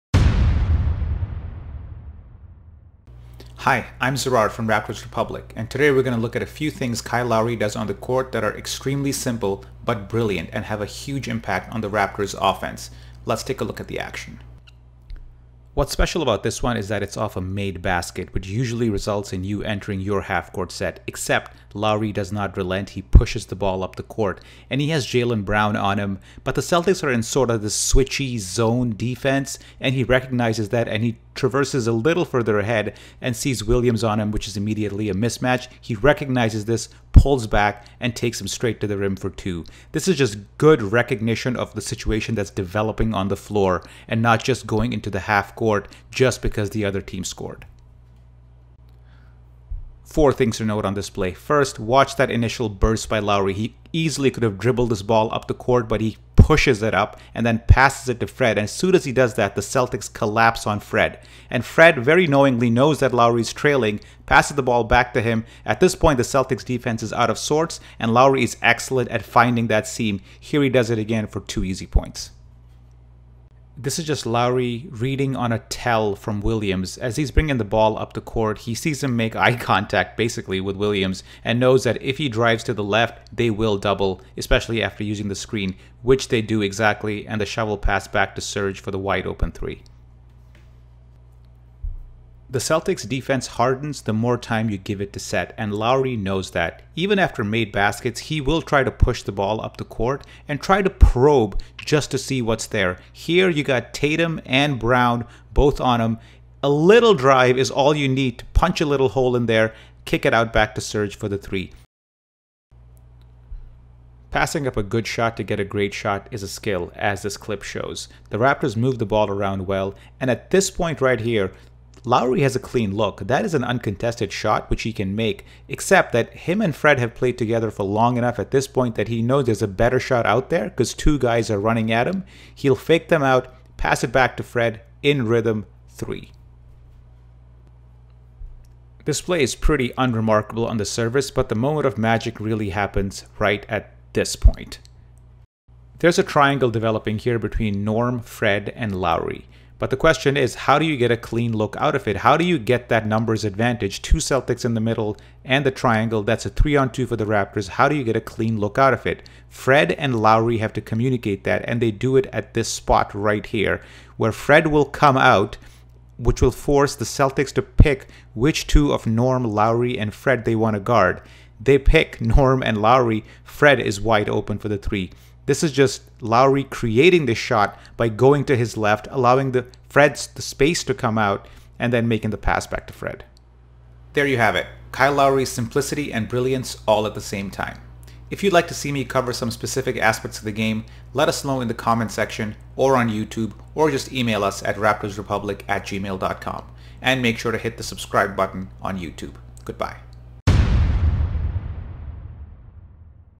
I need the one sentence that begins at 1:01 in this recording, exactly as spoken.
And Fred very knowingly knows that Lowry's trailing, passes the ball back to him.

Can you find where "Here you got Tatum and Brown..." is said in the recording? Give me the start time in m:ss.
1:43.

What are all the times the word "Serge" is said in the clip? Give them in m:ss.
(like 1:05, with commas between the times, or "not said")
1:28, 1:50.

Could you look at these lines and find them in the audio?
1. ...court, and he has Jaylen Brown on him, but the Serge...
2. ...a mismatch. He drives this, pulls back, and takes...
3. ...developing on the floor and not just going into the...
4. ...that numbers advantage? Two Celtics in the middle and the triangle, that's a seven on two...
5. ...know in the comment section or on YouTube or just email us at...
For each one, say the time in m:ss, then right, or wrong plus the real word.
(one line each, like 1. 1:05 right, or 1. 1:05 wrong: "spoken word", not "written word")
1. 0:24 wrong: "Celtics", not "Serge"
2. 0:35 wrong: "recognizes", not "drives"
3. 0:42 right
4. 2:32 wrong: "three", not "seven"
5. 3:11 right.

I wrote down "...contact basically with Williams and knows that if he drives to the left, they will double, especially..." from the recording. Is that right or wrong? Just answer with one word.
right.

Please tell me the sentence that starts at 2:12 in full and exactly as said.
He'll fake them out, pass it back to Fred in rhythm three.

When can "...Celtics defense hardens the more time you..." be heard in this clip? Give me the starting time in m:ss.
1:32.